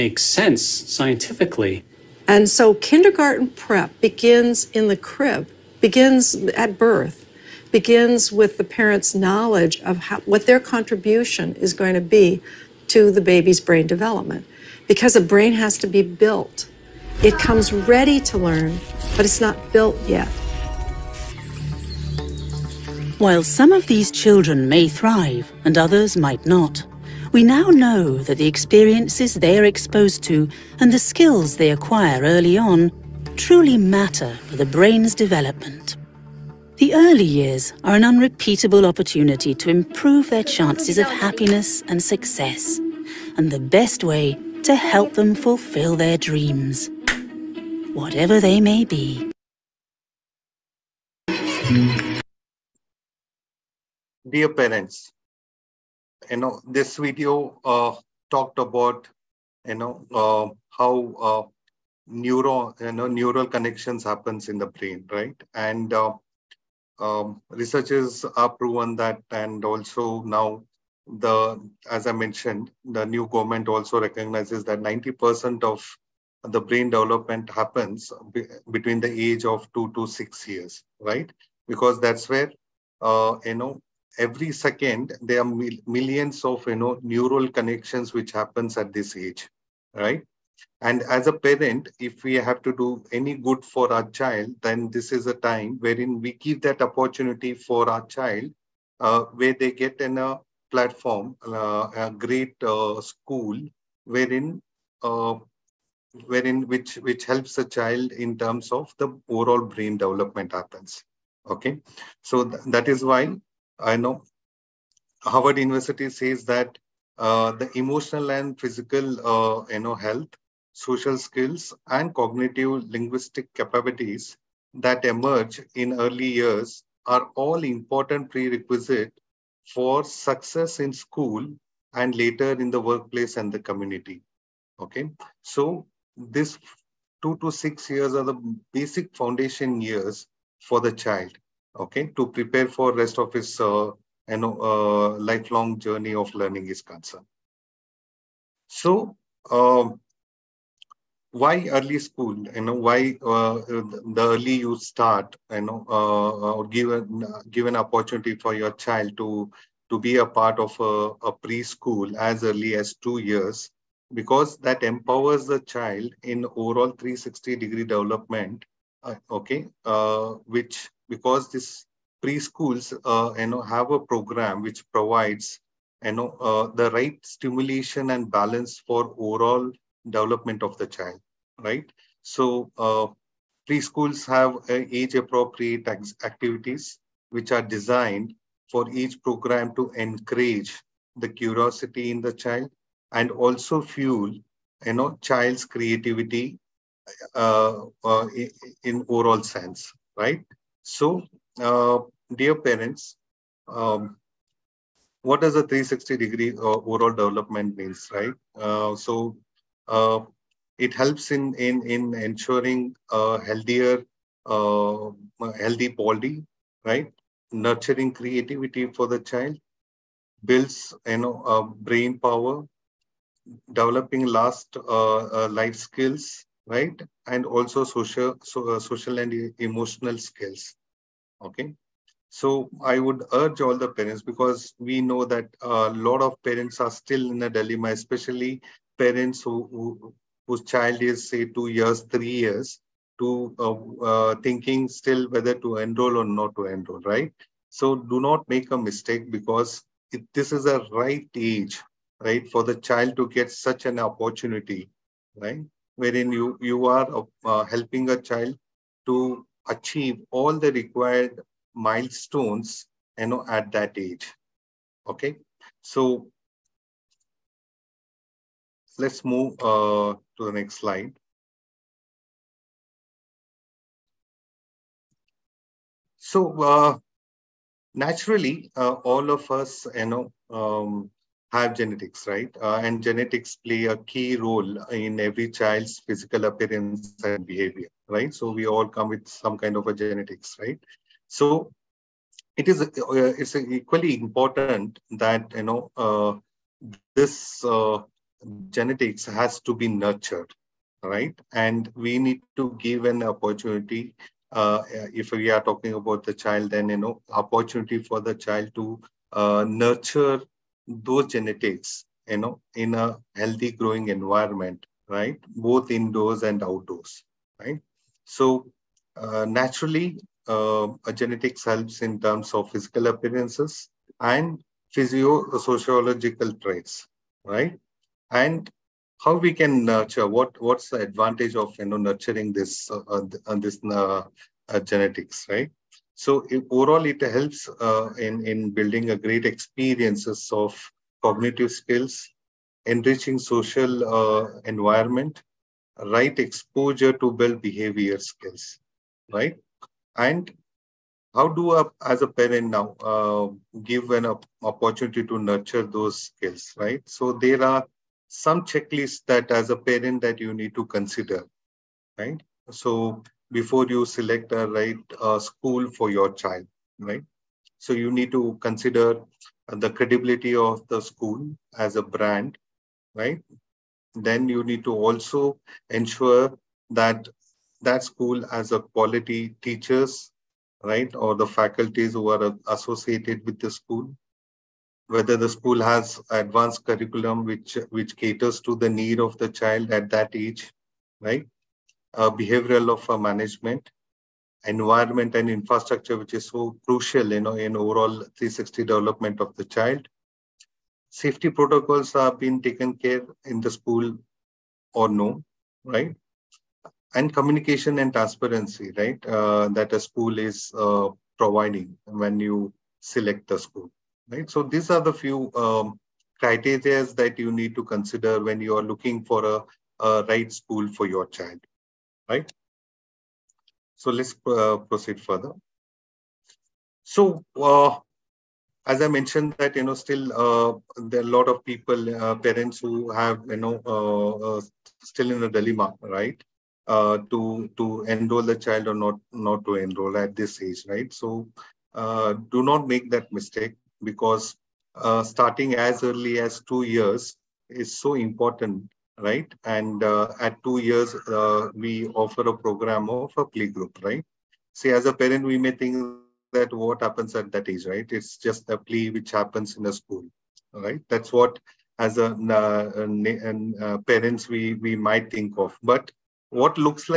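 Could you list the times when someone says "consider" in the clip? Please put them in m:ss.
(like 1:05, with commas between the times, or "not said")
6:00, 6:08, 6:57.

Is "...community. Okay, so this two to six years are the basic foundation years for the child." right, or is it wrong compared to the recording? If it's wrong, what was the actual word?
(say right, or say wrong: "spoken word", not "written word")
right.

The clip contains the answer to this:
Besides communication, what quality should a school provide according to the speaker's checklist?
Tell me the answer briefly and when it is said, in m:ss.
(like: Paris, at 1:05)
Transparency, at 6:48.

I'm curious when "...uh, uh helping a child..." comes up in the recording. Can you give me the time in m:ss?
4:17.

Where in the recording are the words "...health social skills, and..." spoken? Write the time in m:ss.
1:59.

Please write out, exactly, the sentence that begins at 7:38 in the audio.
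It's just a play which happens in a school, right?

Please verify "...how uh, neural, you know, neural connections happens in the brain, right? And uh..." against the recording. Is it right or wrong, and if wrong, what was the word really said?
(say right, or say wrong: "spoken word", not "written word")
right.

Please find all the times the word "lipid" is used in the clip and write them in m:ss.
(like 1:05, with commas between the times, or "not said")
not said.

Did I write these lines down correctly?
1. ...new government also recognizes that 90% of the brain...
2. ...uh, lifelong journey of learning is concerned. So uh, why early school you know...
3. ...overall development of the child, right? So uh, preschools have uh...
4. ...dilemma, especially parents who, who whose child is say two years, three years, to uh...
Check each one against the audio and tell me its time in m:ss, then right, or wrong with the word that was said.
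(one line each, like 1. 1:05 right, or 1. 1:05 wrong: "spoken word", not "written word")
1. 1:13 right
2. 2:24 right
3. 2:59 right
4. 3:57 right.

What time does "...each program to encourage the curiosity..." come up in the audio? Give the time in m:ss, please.
3:08.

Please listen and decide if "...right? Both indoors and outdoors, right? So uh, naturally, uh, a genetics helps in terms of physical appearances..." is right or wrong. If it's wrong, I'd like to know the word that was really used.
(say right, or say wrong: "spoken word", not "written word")
right.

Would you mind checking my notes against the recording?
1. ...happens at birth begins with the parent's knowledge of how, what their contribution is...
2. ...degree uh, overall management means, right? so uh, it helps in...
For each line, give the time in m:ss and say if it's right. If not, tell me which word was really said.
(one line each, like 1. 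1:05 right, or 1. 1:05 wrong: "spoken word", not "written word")
1. 0:05 wrong: "begins", not "happens"
2. 3:26 wrong: "development", not "management".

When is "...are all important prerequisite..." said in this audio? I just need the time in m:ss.
2:07.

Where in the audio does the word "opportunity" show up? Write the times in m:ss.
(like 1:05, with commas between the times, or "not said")
0:38, 1:36, 2:37, 4:13, 5:03, 5:07, 5:54.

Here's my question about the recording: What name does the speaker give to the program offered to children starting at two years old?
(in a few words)
Play group.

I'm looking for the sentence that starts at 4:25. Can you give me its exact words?
Okay, so Let's move uh, to the next slide.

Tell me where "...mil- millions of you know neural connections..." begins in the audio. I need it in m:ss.
1:25.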